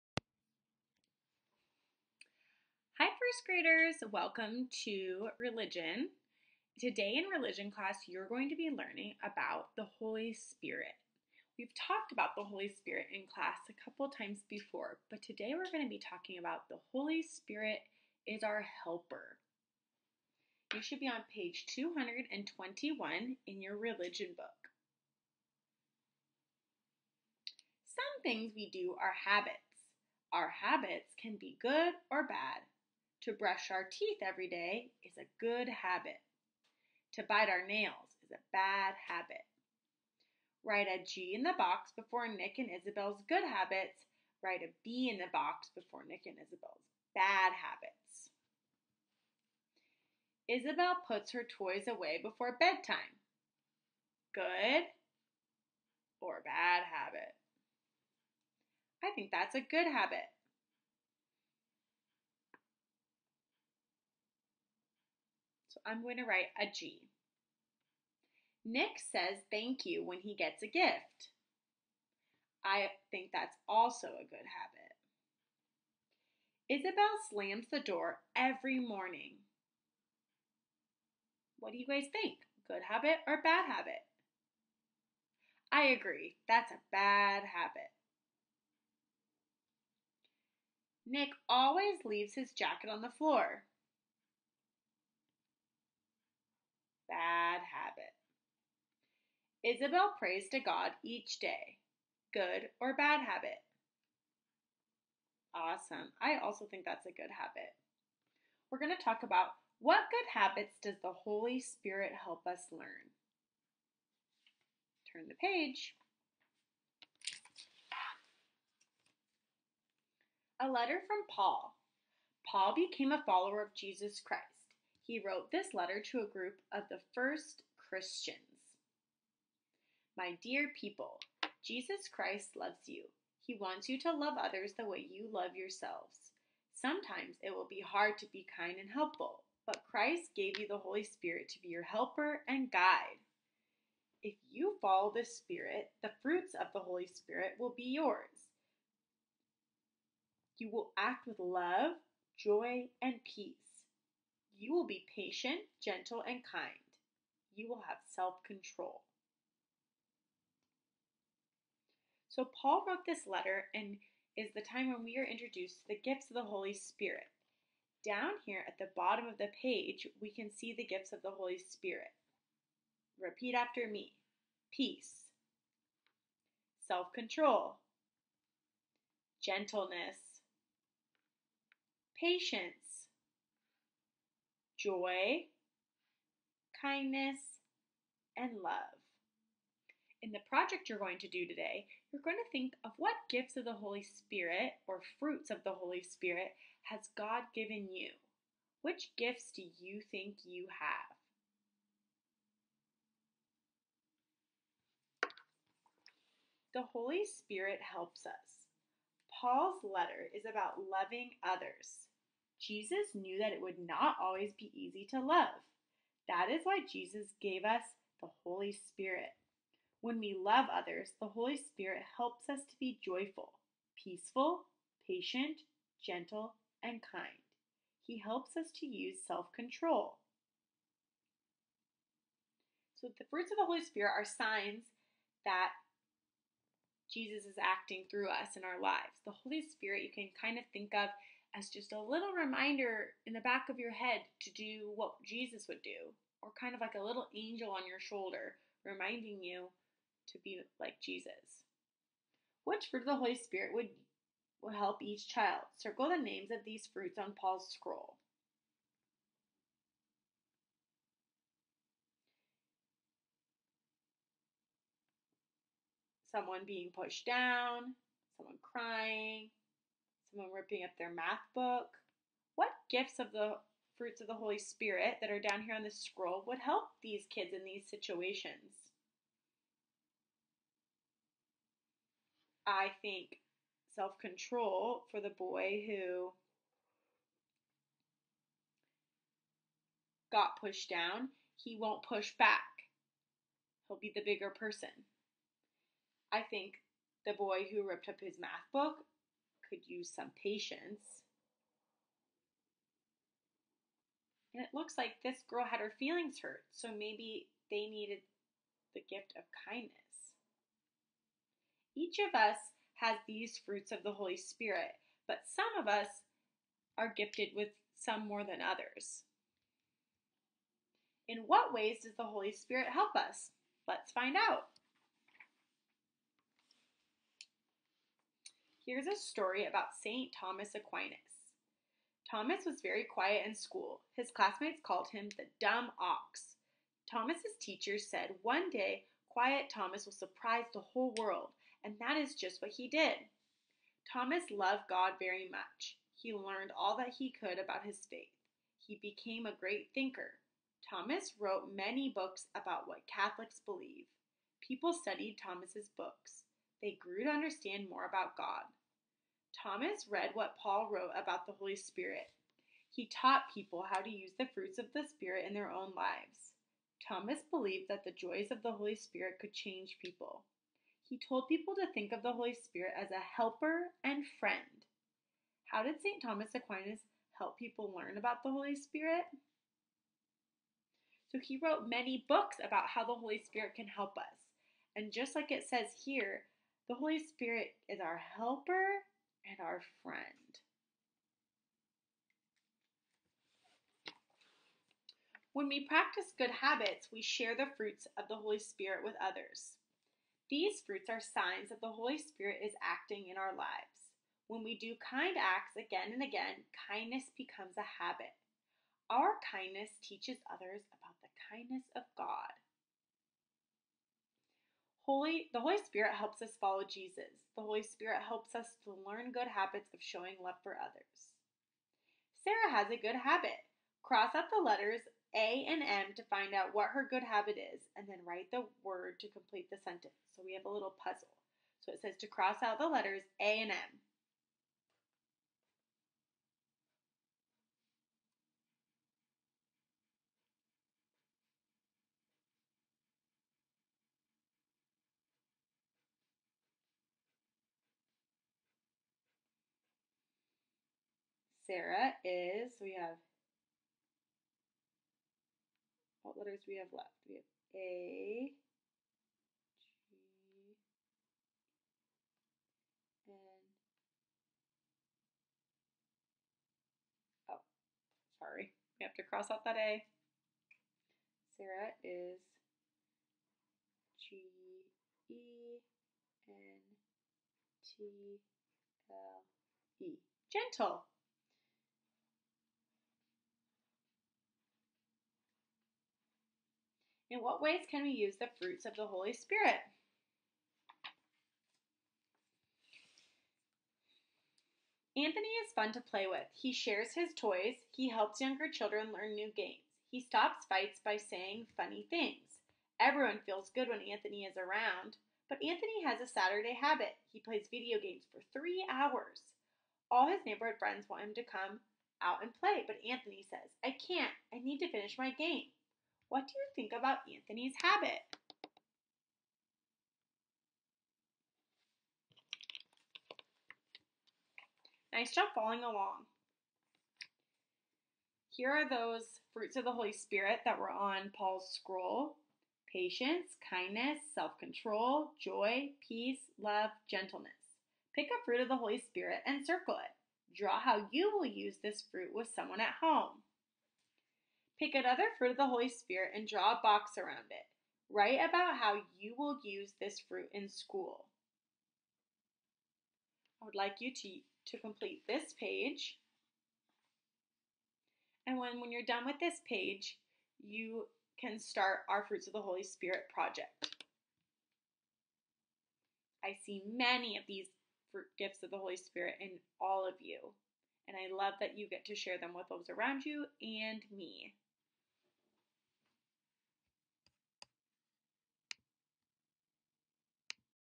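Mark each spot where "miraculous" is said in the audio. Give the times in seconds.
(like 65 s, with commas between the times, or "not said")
not said.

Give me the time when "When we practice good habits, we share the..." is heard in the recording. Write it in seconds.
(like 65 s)
395 s.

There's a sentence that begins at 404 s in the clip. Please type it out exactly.
When we do kind acts again and again, kindness becomes a habit.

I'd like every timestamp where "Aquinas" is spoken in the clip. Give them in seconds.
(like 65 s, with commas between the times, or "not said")
330 s, 376 s.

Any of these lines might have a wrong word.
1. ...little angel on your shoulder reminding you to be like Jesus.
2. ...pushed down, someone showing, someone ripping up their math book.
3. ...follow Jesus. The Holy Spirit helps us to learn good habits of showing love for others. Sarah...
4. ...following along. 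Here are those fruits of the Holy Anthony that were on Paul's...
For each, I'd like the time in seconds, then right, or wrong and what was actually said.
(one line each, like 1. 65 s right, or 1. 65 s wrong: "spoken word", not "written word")
1. 247 s right
2. 266 s wrong: "crying", not "showing"
3. 416 s right
4. 525 s wrong: "Spirit", not "Anthony".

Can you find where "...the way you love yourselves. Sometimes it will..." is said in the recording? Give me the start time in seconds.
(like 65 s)
134 s.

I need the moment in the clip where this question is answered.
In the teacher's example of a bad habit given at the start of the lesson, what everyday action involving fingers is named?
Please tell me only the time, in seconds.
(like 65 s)
37 s.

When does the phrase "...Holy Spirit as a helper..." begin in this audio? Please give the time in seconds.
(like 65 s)
372 s.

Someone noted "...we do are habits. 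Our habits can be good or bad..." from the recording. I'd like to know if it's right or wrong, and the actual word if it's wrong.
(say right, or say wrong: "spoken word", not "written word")
right.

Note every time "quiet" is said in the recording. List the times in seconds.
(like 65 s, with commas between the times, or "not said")
333 s, 339 s.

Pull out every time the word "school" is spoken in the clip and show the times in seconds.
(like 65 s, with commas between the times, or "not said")
333 s, 550 s.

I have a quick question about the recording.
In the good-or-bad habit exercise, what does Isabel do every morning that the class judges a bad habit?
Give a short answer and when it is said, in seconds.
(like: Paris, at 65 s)
Slams the door, at 77 s.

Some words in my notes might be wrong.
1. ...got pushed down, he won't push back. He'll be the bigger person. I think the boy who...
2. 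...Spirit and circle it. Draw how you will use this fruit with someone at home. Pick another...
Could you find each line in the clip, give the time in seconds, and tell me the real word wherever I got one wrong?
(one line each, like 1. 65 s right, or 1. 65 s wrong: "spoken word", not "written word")
1. 290 s right
2. 538 s right.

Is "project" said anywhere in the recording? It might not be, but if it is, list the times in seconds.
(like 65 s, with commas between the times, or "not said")
190 s, 563 s.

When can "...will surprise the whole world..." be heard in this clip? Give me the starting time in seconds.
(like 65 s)
340 s.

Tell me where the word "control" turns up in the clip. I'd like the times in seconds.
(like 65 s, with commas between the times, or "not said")
158 s, 177 s, 229 s, 284 s, 534 s.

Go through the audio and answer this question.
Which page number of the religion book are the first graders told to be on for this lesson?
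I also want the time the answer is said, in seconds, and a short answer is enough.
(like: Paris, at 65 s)
221, at 21 s.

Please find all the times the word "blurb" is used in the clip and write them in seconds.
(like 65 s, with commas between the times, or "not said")
not said.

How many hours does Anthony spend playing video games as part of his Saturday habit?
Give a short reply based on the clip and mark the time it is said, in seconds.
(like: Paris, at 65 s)
3, at 508 s.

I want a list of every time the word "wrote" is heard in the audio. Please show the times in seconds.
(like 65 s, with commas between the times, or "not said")
125 s, 162 s, 351 s, 360 s, 381 s.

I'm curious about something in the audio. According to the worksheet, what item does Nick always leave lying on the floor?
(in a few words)
His jacket.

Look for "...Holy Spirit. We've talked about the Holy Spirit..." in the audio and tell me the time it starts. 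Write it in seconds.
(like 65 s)
9 s.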